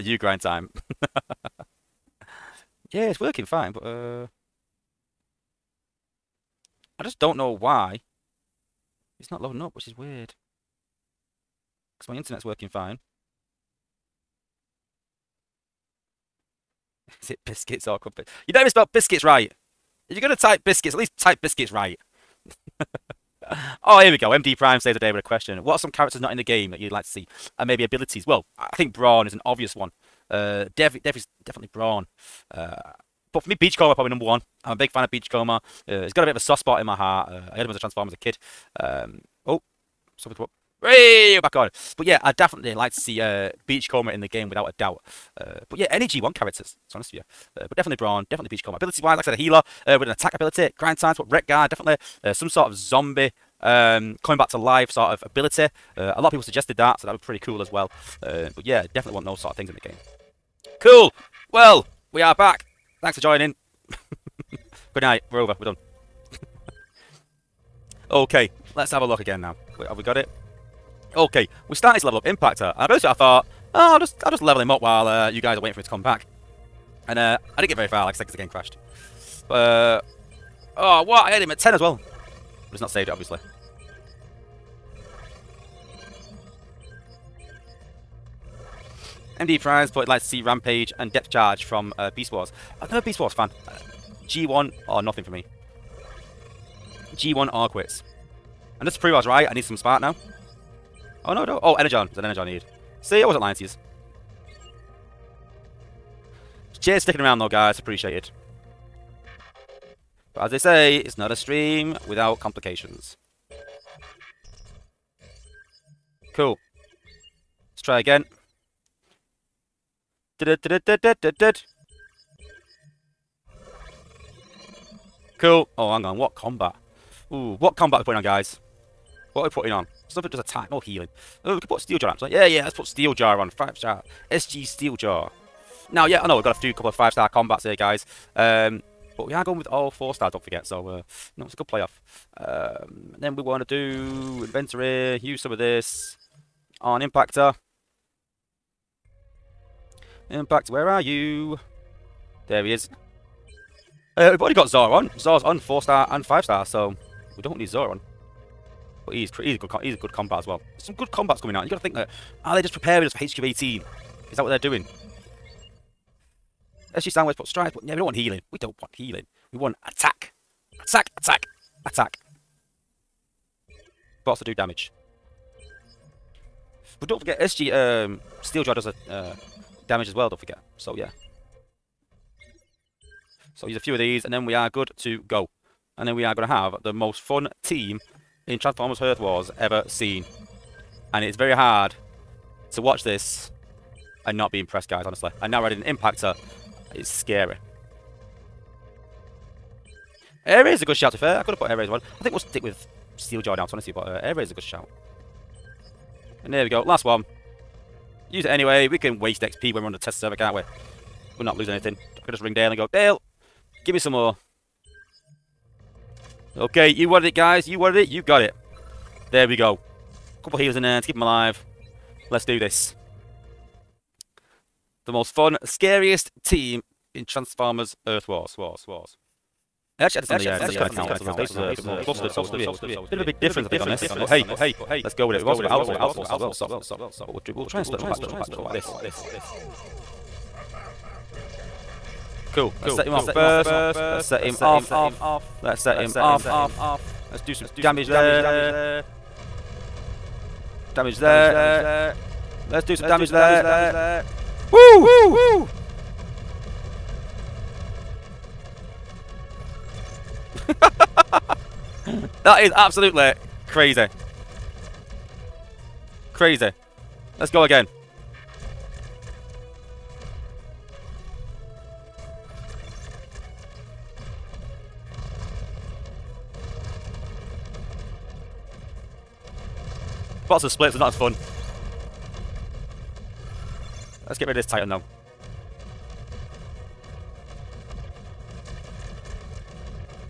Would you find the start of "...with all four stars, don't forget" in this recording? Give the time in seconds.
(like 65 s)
139 s.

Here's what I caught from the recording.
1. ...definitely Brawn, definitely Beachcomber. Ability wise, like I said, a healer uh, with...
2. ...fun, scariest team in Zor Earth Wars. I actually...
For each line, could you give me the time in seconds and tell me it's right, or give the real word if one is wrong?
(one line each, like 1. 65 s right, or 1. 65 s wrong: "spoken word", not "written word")
1. 47 s right
2. 225 s wrong: "Transformers", not "Zor".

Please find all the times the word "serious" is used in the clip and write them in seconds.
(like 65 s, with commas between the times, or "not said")
not said.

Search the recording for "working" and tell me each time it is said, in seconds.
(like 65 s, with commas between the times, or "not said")
3 s, 12 s.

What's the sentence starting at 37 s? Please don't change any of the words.
Uh, I heard him as a Transformer as a kid.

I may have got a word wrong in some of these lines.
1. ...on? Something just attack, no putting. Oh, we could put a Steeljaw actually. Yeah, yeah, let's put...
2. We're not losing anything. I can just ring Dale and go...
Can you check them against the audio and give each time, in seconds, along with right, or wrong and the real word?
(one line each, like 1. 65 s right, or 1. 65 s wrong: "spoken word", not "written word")
1. 129 s wrong: "healing", not "putting"
2. 211 s right.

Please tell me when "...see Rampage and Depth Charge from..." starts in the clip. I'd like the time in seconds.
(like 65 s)
90 s.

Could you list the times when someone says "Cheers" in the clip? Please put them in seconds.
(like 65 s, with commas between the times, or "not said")
106 s.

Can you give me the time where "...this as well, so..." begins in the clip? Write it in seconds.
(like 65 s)
236 s.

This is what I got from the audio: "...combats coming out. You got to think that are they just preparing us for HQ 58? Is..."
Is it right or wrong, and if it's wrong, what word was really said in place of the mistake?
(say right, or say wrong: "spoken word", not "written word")
wrong: "18", not "58".